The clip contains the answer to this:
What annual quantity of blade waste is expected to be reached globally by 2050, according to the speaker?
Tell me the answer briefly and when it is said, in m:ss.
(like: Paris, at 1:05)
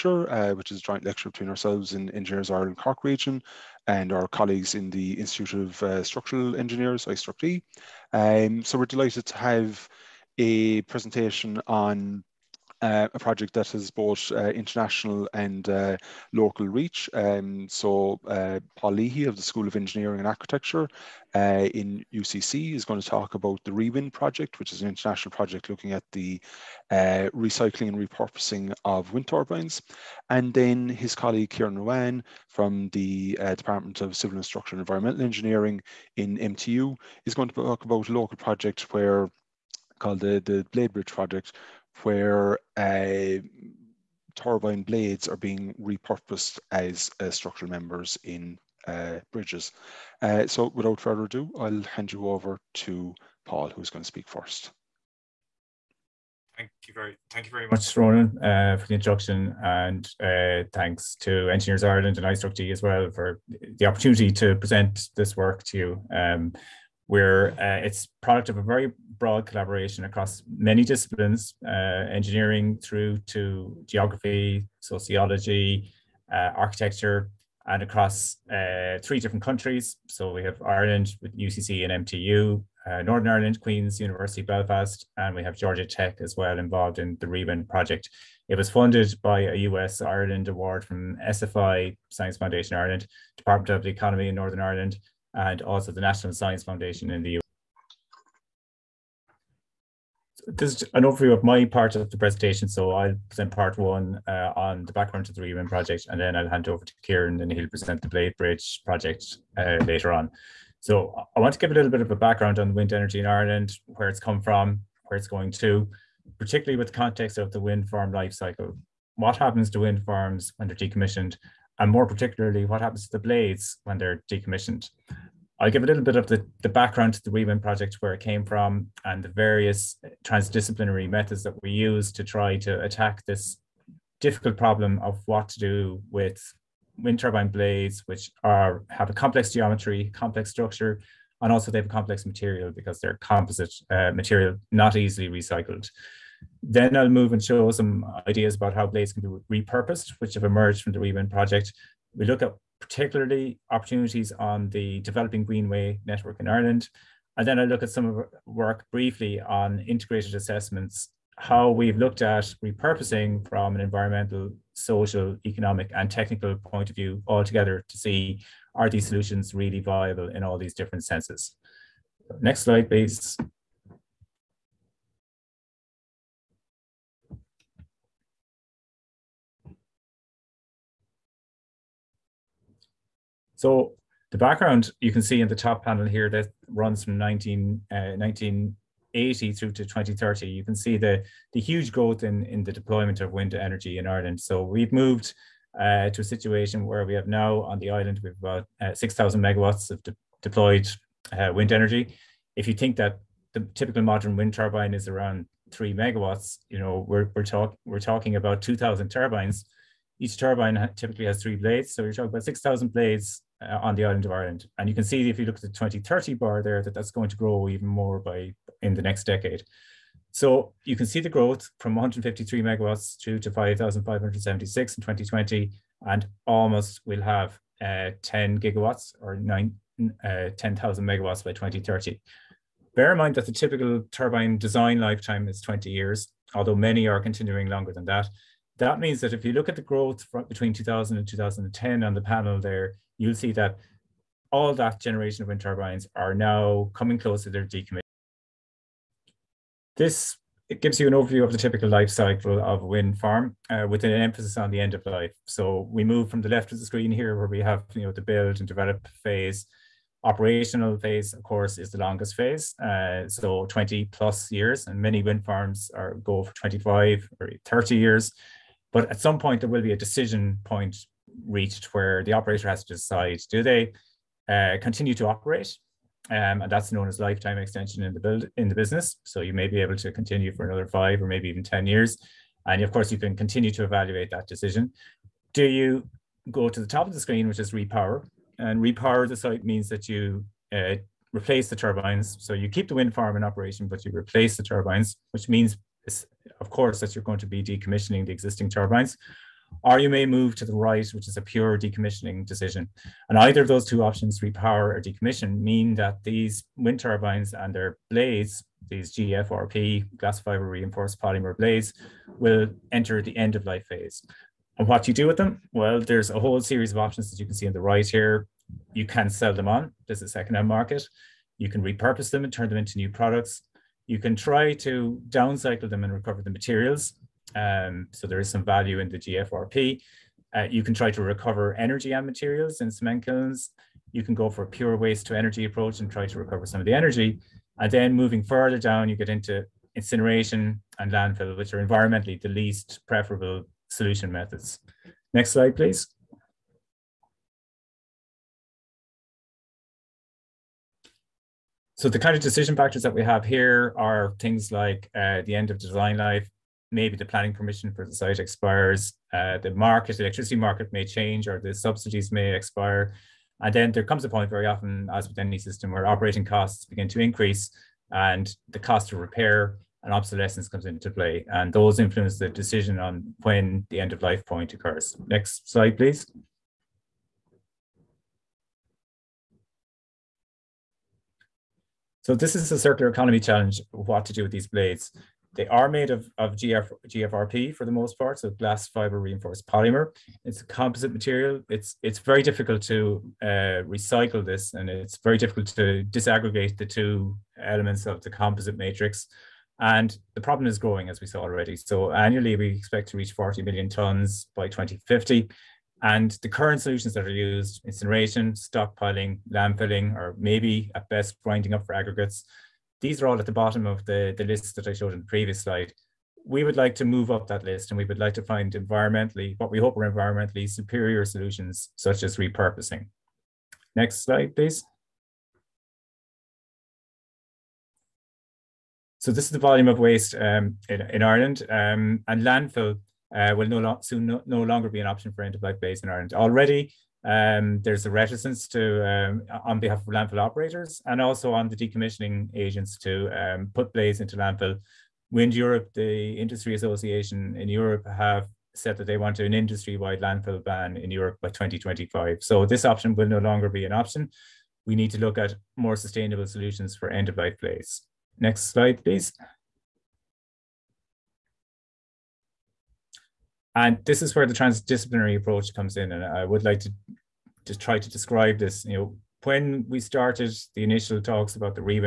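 40 million tons, at 6:43.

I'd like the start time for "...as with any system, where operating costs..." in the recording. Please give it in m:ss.
6:05.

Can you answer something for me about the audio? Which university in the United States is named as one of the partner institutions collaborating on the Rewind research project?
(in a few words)
Georgia Tech.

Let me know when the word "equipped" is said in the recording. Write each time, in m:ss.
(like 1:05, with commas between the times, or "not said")
not said.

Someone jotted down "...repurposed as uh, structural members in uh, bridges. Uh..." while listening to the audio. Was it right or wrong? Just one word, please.
right.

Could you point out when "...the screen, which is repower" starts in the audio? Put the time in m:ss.
4:47.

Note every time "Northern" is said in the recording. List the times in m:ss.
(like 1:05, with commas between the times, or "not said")
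1:23, 1:34.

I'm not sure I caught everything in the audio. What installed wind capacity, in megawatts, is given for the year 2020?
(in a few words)
5,576.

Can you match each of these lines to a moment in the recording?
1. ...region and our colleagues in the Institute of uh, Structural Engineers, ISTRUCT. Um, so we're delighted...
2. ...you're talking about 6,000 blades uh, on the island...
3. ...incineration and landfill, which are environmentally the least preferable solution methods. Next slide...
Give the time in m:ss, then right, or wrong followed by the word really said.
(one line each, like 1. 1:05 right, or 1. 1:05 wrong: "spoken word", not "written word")
1. 0:03 right
2. 3:32 right
3. 5:39 right.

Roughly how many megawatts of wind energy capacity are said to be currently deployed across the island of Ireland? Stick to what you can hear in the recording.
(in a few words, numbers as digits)
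6,000 megawatts.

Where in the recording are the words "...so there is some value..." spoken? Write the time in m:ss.
5:28.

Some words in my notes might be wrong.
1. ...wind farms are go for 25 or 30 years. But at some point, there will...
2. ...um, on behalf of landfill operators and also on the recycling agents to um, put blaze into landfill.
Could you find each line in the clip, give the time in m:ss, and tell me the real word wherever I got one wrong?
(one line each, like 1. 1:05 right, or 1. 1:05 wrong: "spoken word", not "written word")
1. 4:25 right
2. 7:19 wrong: "decommissioning", not "recycling".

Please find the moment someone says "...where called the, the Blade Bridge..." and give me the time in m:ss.
0:38.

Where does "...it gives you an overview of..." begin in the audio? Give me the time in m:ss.
4:10.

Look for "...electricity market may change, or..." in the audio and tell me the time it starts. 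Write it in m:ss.
6:00.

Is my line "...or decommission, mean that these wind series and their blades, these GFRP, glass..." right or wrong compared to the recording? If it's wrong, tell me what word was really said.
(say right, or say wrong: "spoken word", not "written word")
wrong: "turbines", not "series".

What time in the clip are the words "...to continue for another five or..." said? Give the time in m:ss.
4:39.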